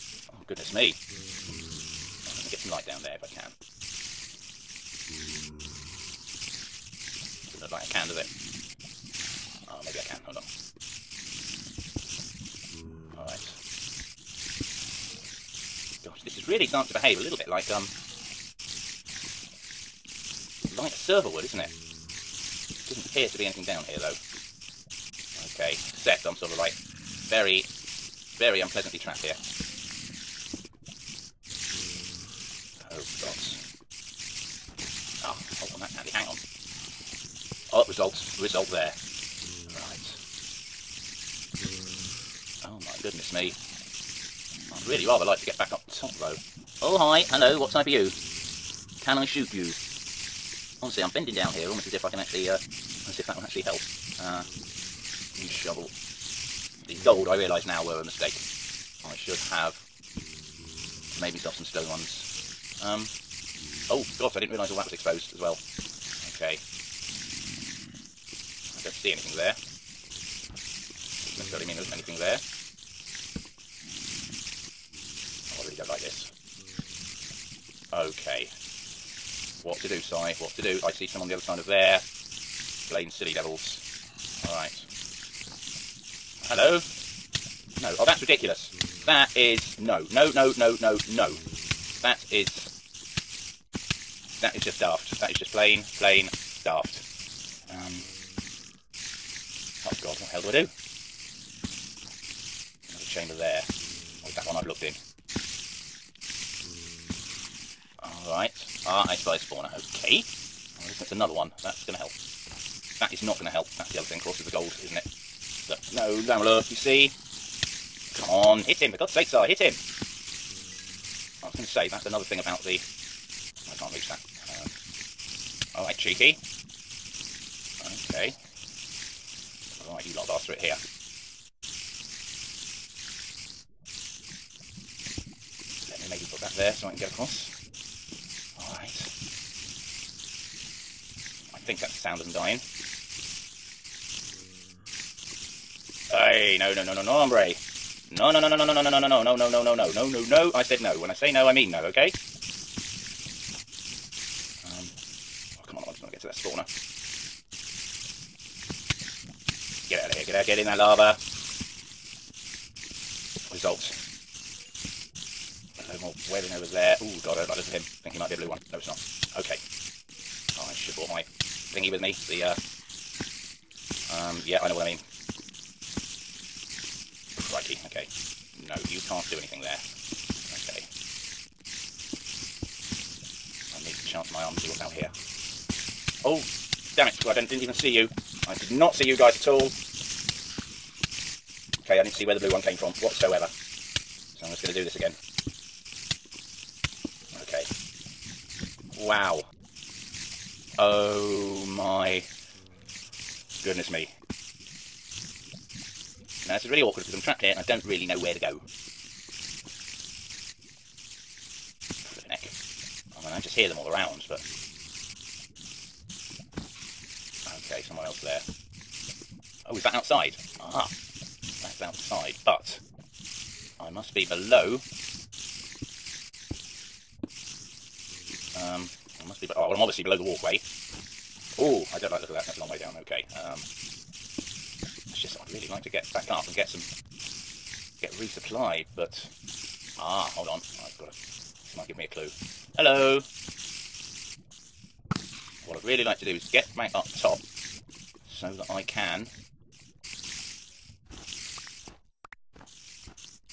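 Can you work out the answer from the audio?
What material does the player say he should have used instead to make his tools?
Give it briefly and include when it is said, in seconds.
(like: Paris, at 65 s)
Stone, at 61 s.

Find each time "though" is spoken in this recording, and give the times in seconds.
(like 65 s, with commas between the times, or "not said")
23 s, 46 s.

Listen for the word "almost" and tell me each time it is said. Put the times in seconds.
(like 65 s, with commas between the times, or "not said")
51 s.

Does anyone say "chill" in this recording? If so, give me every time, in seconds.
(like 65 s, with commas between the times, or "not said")
not said.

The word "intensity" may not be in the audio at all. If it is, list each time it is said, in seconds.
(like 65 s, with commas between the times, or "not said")
not said.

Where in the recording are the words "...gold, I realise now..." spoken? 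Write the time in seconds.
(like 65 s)
57 s.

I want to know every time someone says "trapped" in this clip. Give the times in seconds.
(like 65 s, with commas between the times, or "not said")
28 s, 207 s.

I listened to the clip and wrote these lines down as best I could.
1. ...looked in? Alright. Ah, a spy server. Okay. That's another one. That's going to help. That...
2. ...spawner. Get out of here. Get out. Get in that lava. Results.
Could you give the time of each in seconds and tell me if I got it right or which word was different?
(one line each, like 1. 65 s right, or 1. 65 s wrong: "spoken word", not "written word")
1. 104 s wrong: "spawner", not "server"
2. 156 s right.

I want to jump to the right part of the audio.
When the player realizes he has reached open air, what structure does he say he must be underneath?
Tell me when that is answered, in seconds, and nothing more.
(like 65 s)
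230 s.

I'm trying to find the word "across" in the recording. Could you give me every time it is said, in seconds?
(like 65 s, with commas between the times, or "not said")
137 s.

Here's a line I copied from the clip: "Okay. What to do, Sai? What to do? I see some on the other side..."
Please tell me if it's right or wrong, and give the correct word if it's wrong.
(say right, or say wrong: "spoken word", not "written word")
right.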